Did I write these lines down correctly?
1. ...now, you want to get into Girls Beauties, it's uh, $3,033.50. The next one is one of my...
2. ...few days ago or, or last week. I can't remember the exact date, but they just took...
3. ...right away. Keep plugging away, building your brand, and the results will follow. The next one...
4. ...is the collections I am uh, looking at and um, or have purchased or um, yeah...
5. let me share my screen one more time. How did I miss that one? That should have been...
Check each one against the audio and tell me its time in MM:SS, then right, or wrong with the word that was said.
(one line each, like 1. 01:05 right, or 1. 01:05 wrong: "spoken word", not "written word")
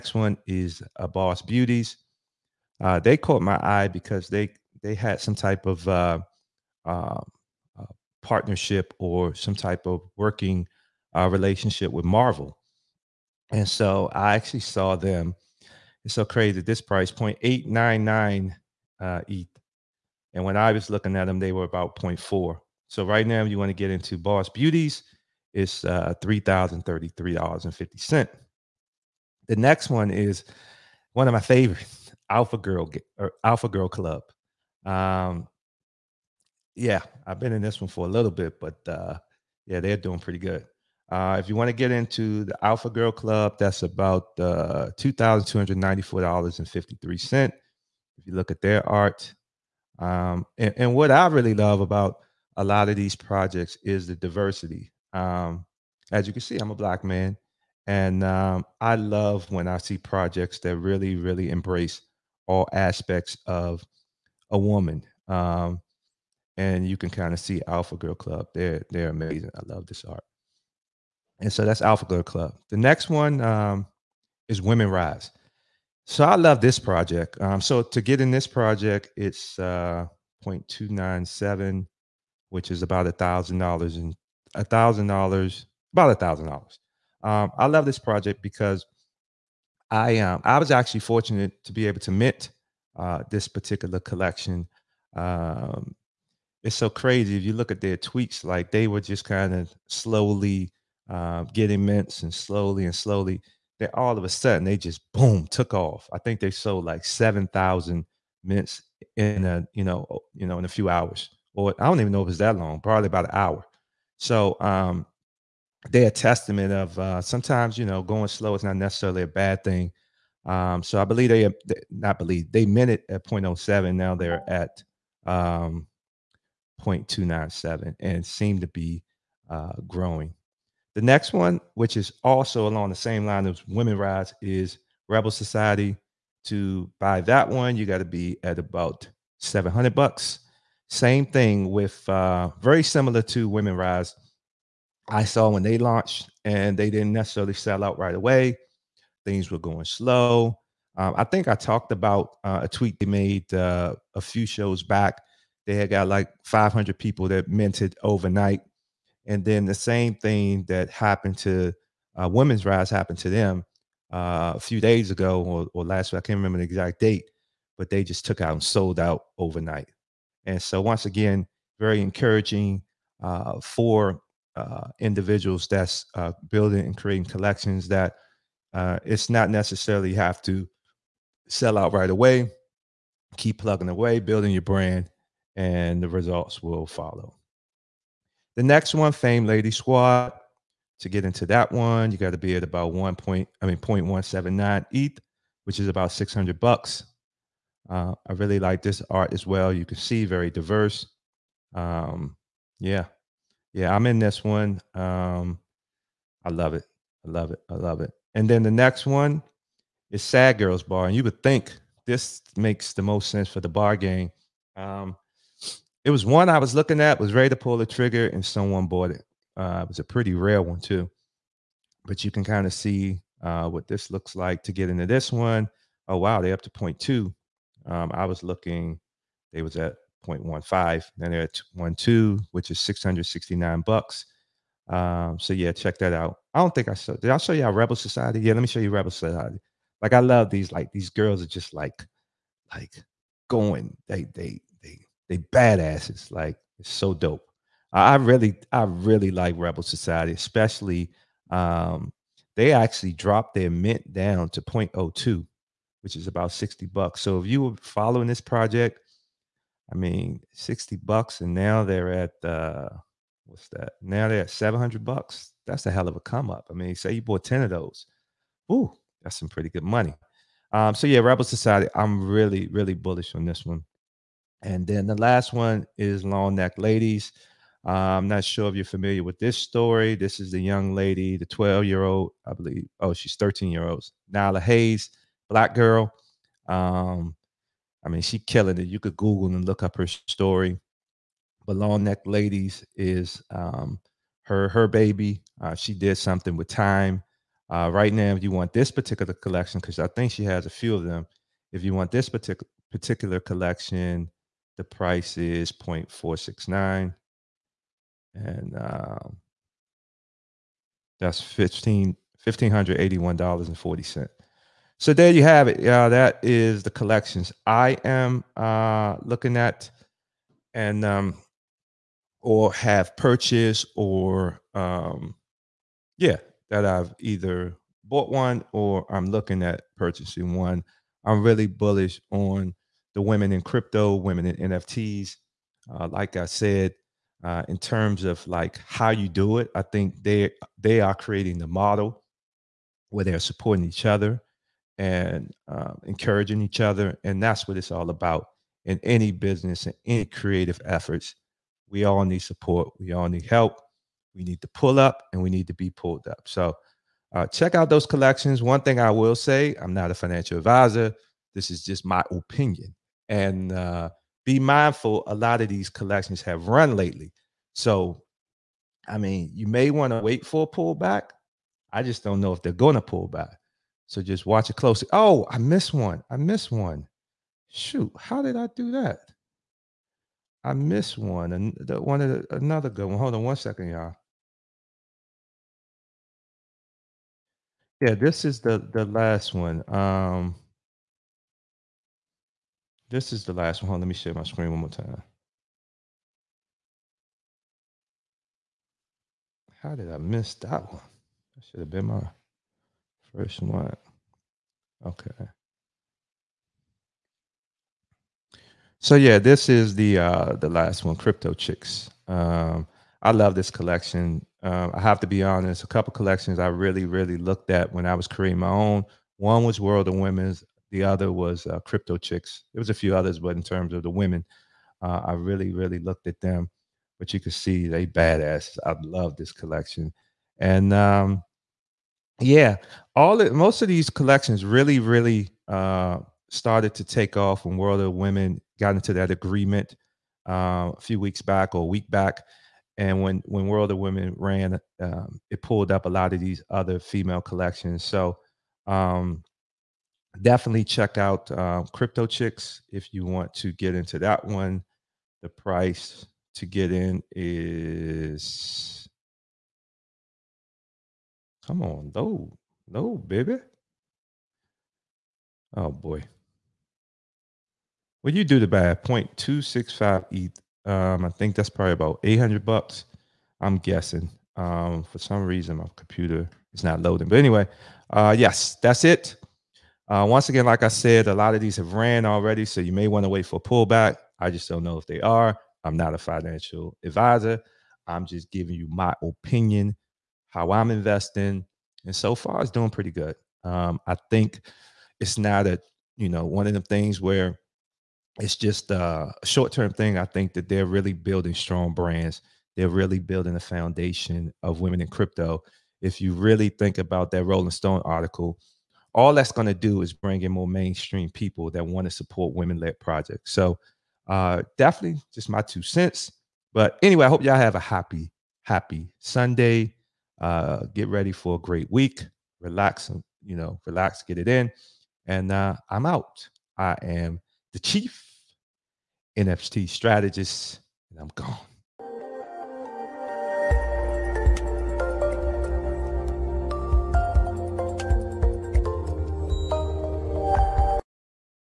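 1. 00:23 wrong: "Boss", not "Girls"
2. 02:44 right
3. 03:01 right
4. 05:16 right
5. 06:33 right.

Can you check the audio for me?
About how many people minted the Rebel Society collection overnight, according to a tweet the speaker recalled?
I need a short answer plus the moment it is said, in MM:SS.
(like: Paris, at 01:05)
500, at 02:36.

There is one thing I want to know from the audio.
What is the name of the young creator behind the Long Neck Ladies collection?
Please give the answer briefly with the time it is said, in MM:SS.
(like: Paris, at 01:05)
Nyla Hayes, at 04:44.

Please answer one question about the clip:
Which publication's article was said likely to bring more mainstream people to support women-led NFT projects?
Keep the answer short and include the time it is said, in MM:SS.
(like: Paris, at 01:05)
Rolling Stone, at 08:27.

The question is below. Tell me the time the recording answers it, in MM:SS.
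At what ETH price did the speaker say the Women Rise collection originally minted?
02:03.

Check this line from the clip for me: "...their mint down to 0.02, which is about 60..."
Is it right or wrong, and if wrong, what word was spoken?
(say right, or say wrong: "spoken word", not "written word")
right.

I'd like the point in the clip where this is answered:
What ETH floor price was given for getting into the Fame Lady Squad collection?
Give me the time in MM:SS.
03:13.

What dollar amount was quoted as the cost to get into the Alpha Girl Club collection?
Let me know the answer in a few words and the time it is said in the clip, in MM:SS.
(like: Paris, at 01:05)
$2,294.53, at 00:44.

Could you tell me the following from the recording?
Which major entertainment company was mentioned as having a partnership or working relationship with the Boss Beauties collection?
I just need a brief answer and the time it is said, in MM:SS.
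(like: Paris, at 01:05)
Marvel, at 00:12.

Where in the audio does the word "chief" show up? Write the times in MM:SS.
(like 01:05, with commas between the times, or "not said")
08:47.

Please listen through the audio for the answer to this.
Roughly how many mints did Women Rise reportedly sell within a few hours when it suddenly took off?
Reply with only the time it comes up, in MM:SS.
01:47.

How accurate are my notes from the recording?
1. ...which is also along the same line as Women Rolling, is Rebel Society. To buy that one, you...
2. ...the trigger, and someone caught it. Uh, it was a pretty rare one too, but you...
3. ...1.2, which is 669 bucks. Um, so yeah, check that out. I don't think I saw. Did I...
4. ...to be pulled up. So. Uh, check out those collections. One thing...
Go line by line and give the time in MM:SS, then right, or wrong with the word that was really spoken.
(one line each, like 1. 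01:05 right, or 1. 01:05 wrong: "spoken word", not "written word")
1. 02:11 wrong: "Rise", not "Rolling"
2. 03:37 wrong: "bought", not "caught"
3. 03:51 right
4. 05:55 right.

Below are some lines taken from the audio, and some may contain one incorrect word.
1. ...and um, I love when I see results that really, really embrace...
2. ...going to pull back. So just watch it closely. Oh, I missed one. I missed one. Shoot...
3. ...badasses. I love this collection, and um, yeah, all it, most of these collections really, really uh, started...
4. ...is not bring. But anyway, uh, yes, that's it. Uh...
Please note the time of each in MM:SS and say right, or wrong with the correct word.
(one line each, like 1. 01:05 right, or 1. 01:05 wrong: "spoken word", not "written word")
1. 00:57 wrong: "projects", not "results"
2. 06:12 right
3. 07:08 right
4. 07:56 wrong: "loading", not "bring".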